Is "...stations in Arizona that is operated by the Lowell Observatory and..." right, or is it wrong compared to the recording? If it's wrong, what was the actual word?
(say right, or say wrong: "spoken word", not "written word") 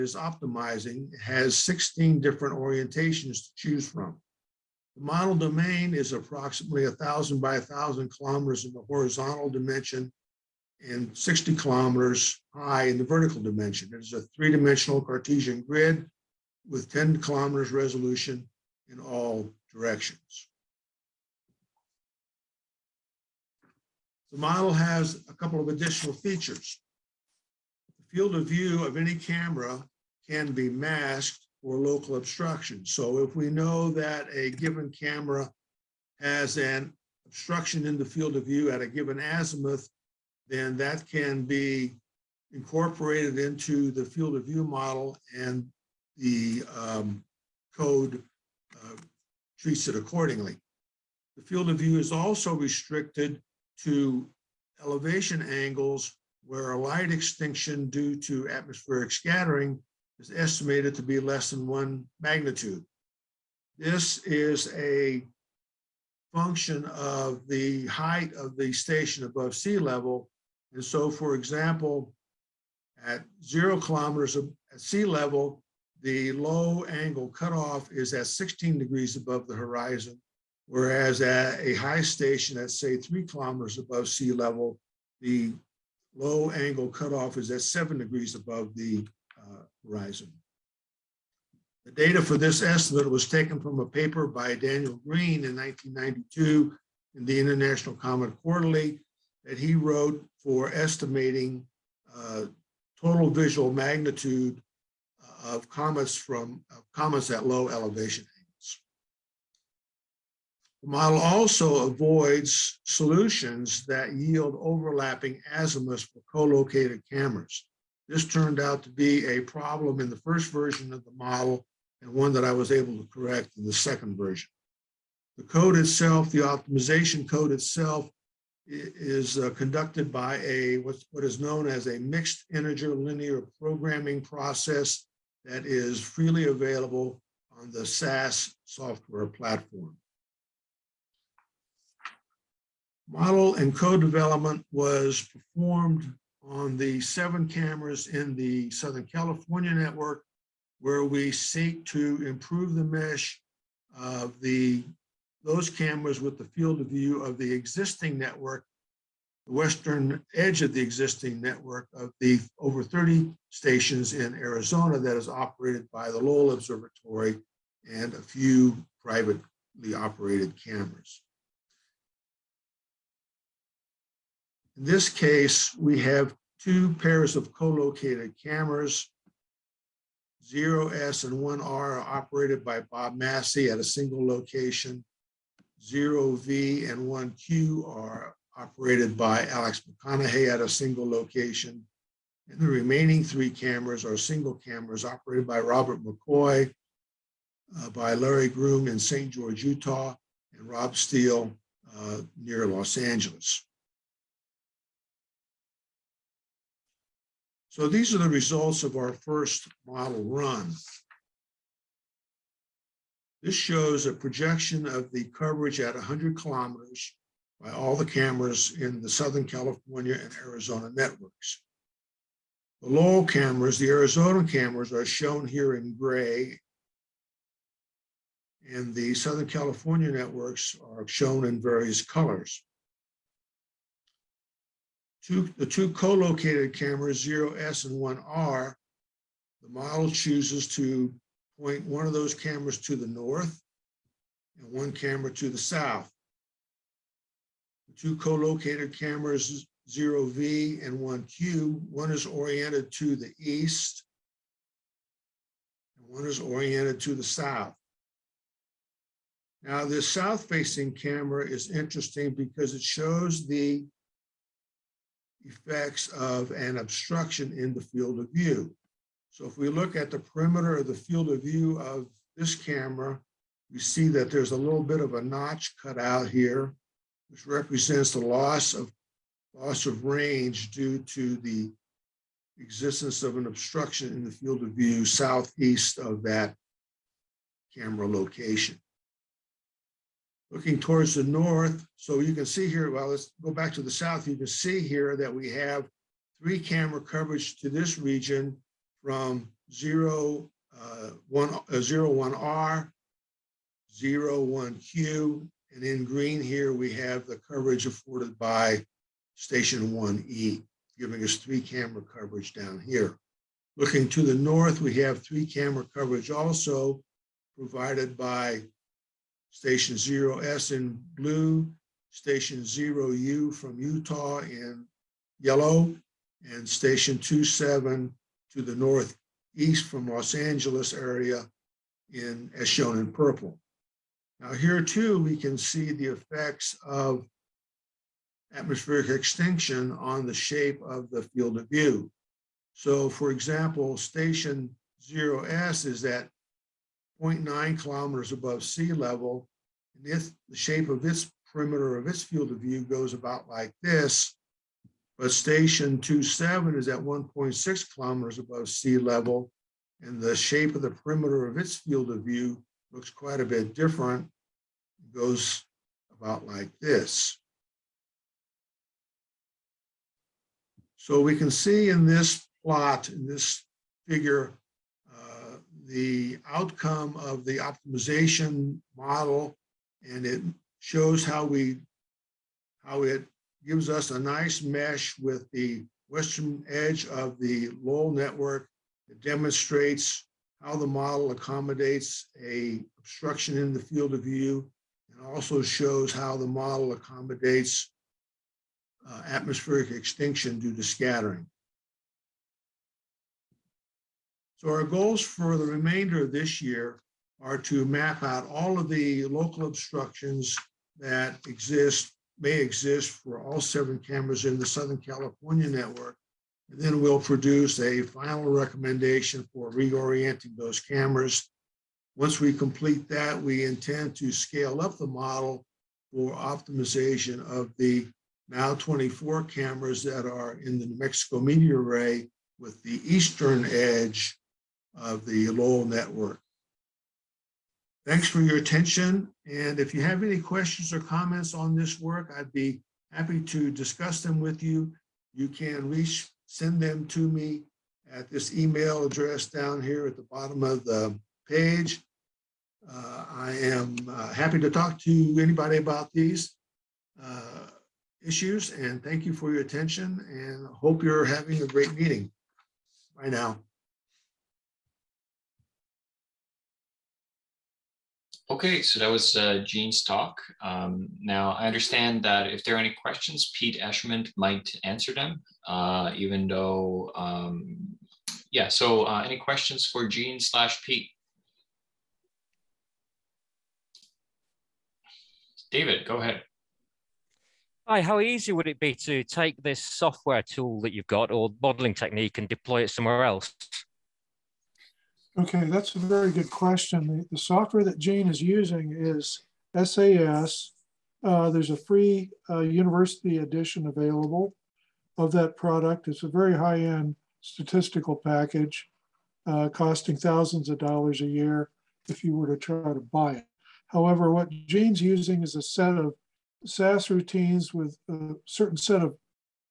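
right.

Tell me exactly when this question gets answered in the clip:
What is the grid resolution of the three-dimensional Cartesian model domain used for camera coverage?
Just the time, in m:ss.
0:16.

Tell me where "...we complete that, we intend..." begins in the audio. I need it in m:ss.
7:02.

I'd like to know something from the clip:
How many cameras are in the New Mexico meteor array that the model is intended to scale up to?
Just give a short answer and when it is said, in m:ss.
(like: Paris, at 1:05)
24, at 7:08.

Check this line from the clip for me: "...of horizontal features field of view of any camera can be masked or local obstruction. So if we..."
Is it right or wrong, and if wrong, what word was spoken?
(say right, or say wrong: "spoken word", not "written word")
wrong: "additional", not "horizontal".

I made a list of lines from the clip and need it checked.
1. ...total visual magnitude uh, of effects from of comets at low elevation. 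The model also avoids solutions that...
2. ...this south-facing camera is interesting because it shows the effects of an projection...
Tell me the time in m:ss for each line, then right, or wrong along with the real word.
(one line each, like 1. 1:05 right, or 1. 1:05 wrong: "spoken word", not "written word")
1. 1:43 wrong: "comets", not "effects"
2. 4:19 wrong: "obstruction", not "projection".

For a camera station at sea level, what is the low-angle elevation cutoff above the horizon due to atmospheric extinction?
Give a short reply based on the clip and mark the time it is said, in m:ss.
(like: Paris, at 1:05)
16 degrees, at 1:18.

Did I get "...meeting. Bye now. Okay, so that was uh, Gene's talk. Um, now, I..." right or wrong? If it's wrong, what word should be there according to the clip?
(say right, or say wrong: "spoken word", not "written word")
right.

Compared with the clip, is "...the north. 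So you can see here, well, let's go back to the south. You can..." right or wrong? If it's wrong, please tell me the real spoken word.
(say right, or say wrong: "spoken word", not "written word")
right.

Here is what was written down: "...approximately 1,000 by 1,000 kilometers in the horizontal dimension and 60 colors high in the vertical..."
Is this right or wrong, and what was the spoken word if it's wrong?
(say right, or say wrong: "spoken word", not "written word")
wrong: "kilometers", not "colors".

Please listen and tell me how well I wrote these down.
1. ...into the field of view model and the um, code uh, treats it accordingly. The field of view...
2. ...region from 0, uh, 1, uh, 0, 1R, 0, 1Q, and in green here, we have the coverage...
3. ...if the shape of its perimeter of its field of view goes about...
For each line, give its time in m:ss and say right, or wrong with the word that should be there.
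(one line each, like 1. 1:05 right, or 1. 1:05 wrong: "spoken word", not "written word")
1. 0:43 right
2. 4:57 right
3. 5:50 right.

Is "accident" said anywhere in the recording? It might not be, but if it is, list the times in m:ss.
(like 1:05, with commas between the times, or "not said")
not said.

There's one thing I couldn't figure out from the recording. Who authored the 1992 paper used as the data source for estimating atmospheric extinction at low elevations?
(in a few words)
Daniel Green.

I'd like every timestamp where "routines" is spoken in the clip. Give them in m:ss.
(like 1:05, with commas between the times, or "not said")
8:37.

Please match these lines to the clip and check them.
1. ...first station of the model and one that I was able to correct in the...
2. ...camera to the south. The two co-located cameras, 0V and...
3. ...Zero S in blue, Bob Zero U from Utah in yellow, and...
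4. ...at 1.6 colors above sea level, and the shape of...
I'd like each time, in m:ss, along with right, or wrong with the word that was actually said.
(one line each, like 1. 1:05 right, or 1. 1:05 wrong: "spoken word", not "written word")
1. 2:00 wrong: "version", not "station"
2. 4:04 right
3. 5:19 wrong: "Station", not "Bob"
4. 5:56 wrong: "kilometers", not "colors".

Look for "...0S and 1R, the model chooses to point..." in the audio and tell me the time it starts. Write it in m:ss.
3:57.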